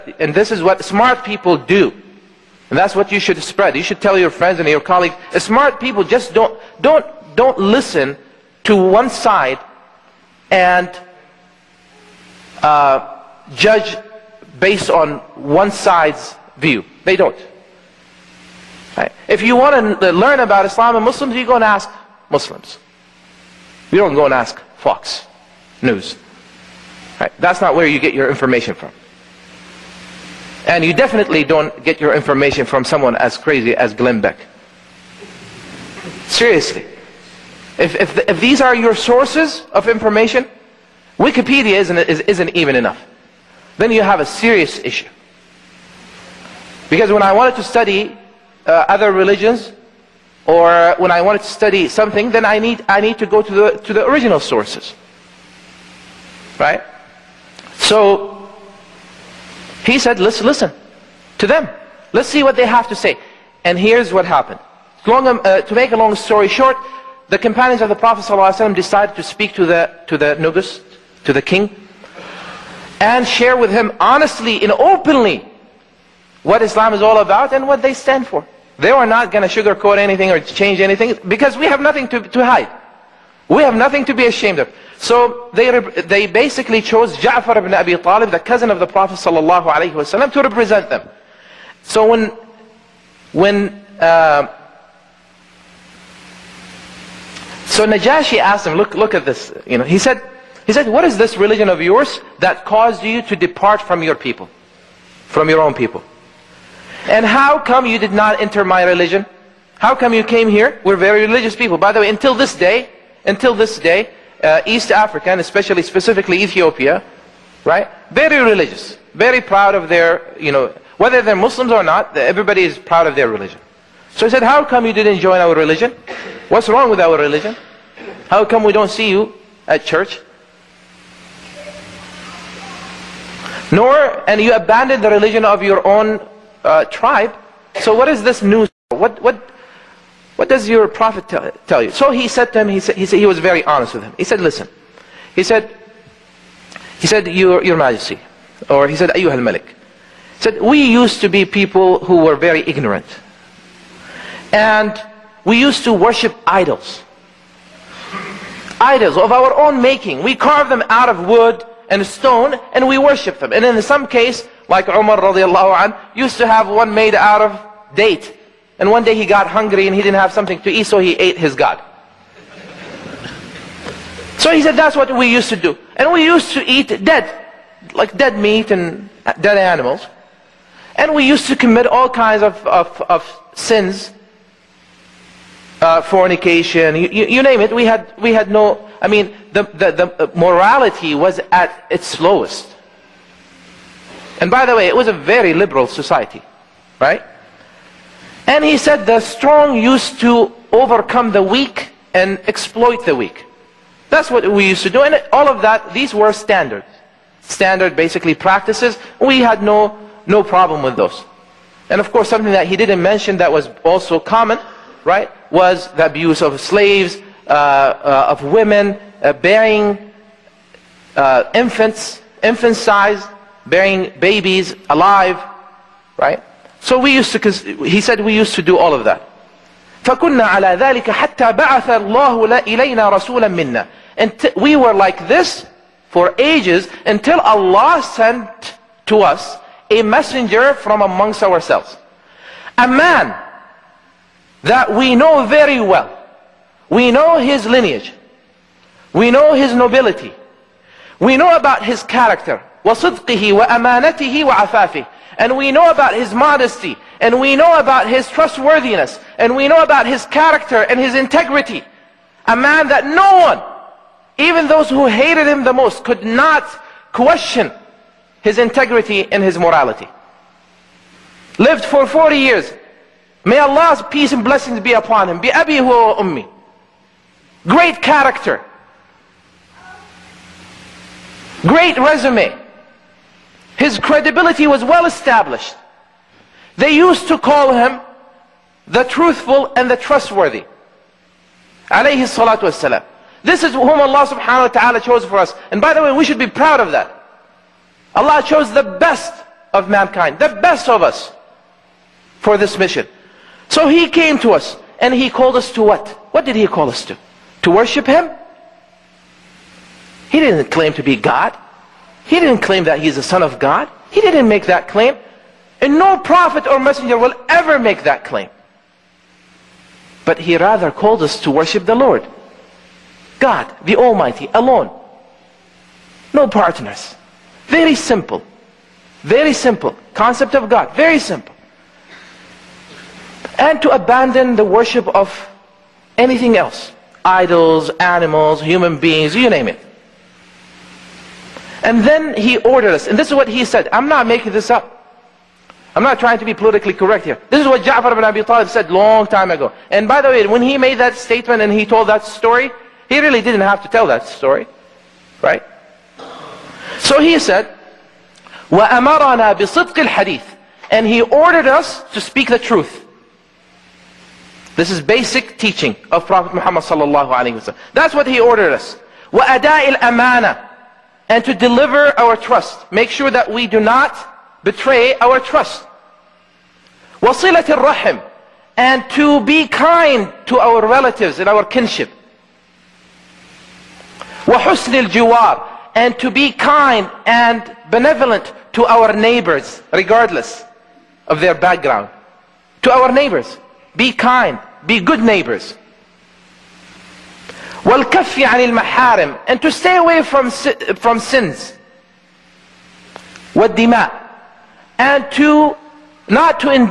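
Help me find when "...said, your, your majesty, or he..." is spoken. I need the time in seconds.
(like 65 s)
147 s.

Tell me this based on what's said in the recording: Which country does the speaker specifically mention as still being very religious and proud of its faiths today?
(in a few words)
Ethiopia.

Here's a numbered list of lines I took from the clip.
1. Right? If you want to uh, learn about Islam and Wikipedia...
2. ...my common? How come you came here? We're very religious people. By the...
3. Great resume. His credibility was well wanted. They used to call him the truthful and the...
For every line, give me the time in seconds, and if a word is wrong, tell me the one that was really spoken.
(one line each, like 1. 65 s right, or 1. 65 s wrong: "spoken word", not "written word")
1. 18 s wrong: "Muslims", not "Wikipedia"
2. 108 s wrong: "religion", not "common"
3. 281 s wrong: "established", not "wanted".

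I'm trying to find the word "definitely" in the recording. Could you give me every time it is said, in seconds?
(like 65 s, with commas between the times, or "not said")
30 s.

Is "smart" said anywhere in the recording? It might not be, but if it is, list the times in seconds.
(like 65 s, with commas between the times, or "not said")
0 s, 5 s.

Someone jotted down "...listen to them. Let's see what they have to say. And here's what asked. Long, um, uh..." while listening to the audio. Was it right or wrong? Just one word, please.
wrong.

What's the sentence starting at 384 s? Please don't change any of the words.
وَحُسْنِ الْجِوَارِ And to be kind and benevolent to our neighbors, regardless of their background.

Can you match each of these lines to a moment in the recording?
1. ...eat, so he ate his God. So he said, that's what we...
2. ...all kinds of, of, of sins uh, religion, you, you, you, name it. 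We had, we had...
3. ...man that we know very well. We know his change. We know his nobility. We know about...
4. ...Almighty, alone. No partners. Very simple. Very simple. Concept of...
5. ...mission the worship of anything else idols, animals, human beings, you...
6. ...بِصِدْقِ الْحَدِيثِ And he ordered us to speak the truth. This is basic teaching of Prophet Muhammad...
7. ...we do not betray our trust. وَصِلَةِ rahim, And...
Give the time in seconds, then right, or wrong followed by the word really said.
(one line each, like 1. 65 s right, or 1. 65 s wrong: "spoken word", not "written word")
1. 170 s right
2. 181 s wrong: "fornication", not "religion"
3. 242 s wrong: "lineage", not "change"
4. 323 s right
5. 333 s wrong: "abandon", not "mission"
6. 359 s right
7. 373 s right.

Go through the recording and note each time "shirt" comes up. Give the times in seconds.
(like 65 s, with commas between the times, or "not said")
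not said.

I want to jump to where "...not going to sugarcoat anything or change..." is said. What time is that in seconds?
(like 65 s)
79 s.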